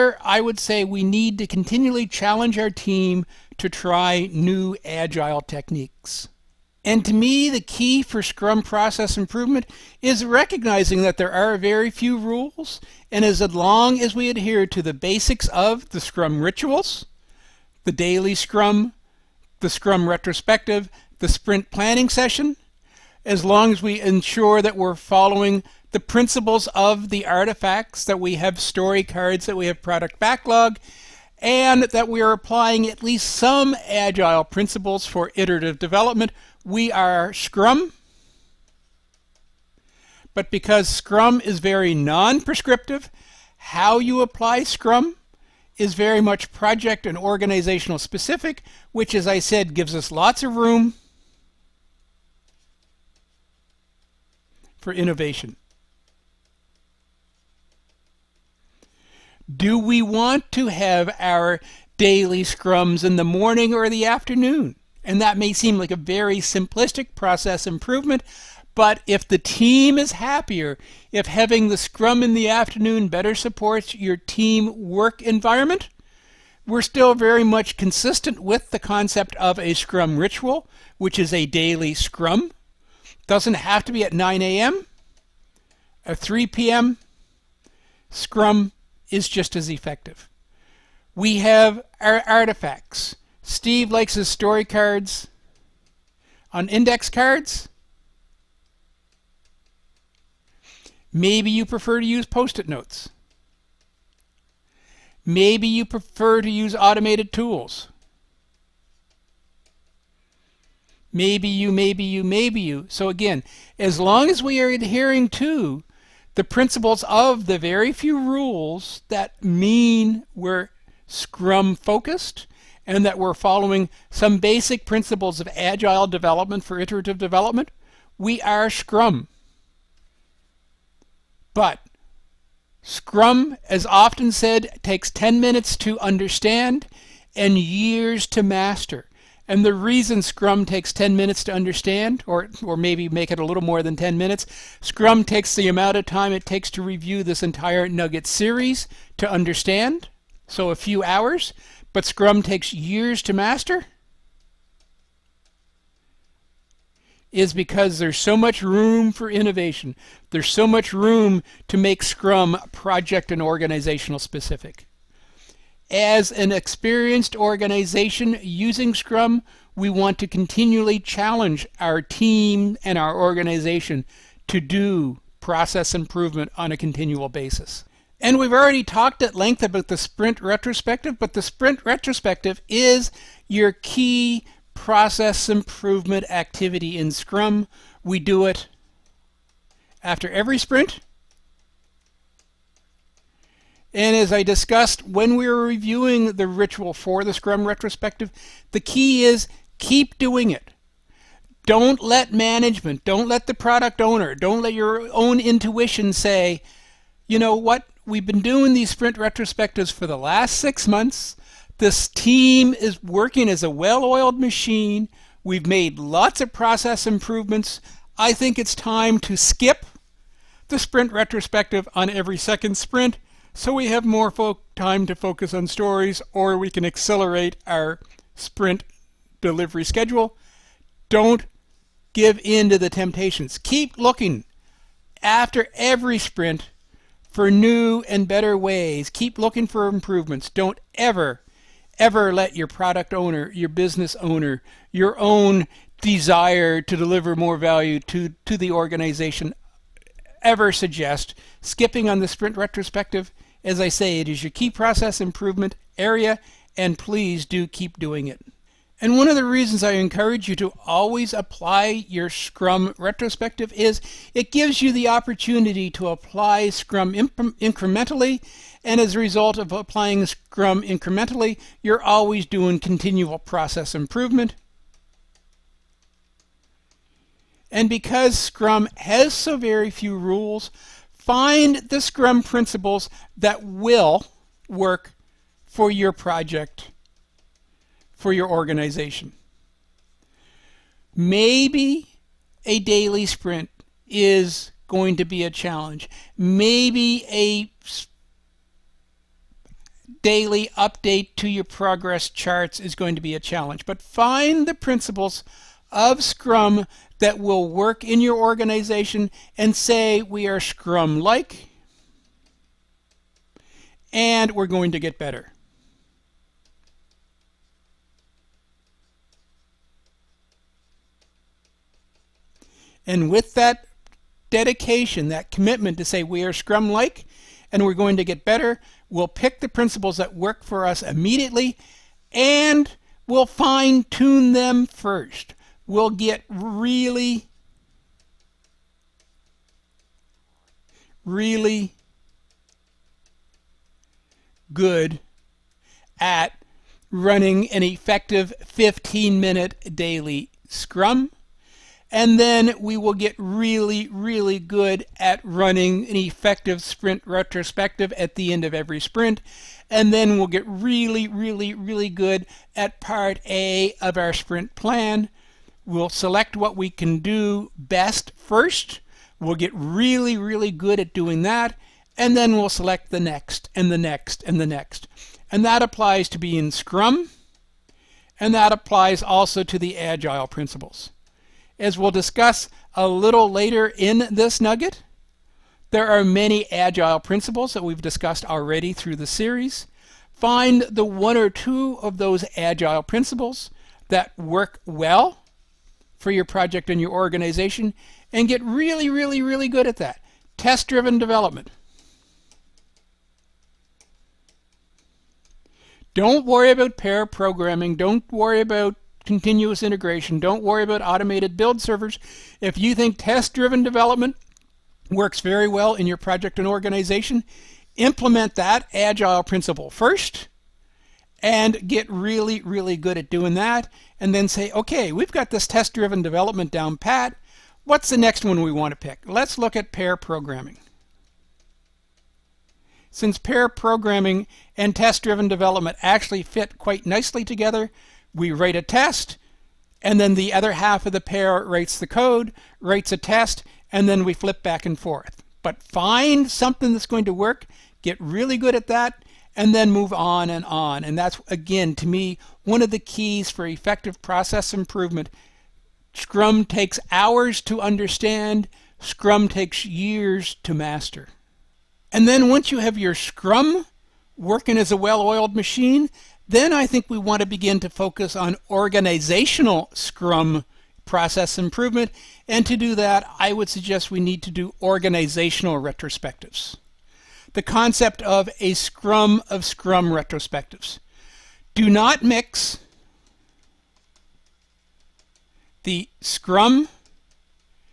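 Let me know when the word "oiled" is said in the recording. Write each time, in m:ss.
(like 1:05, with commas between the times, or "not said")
3:34, 7:45.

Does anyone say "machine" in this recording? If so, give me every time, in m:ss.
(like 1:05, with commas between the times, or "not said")
3:34, 7:45.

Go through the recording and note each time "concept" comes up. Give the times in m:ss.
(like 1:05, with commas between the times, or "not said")
1:18, 7:57.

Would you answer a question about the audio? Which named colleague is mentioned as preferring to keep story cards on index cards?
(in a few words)
Steve.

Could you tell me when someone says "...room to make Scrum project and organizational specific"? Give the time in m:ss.
2:40.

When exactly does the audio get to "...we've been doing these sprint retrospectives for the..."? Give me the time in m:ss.
3:28.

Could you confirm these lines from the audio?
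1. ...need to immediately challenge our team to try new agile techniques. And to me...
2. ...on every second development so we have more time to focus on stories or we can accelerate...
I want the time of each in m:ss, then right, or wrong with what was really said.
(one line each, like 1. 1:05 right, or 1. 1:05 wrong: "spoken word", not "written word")
1. 0:01 wrong: "continually", not "immediately"
2. 3:41 wrong: "sprint", not "development".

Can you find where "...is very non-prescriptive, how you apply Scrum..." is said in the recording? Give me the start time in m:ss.
0:41.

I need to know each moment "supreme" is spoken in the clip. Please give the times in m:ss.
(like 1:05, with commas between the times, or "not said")
not said.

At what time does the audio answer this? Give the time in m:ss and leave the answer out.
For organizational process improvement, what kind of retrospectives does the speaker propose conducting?
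7:58.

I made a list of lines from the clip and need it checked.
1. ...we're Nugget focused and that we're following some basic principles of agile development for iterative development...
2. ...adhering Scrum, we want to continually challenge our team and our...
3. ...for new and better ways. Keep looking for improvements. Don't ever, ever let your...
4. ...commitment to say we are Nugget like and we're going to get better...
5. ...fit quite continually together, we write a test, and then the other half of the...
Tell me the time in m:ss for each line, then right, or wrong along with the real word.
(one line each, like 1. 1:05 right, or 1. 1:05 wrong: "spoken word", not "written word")
1. 2:00 wrong: "Scrum", not "Nugget"
2. 2:48 wrong: "using", not "adhering"
3. 3:57 right
4. 5:25 wrong: "Scrum", not "Nugget"
5. 7:16 wrong: "nicely", not "continually".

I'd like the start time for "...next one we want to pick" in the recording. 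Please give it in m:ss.
7:08.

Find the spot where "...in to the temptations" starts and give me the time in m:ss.
3:52.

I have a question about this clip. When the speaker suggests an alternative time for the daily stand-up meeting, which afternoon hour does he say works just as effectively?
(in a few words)
3 p.m.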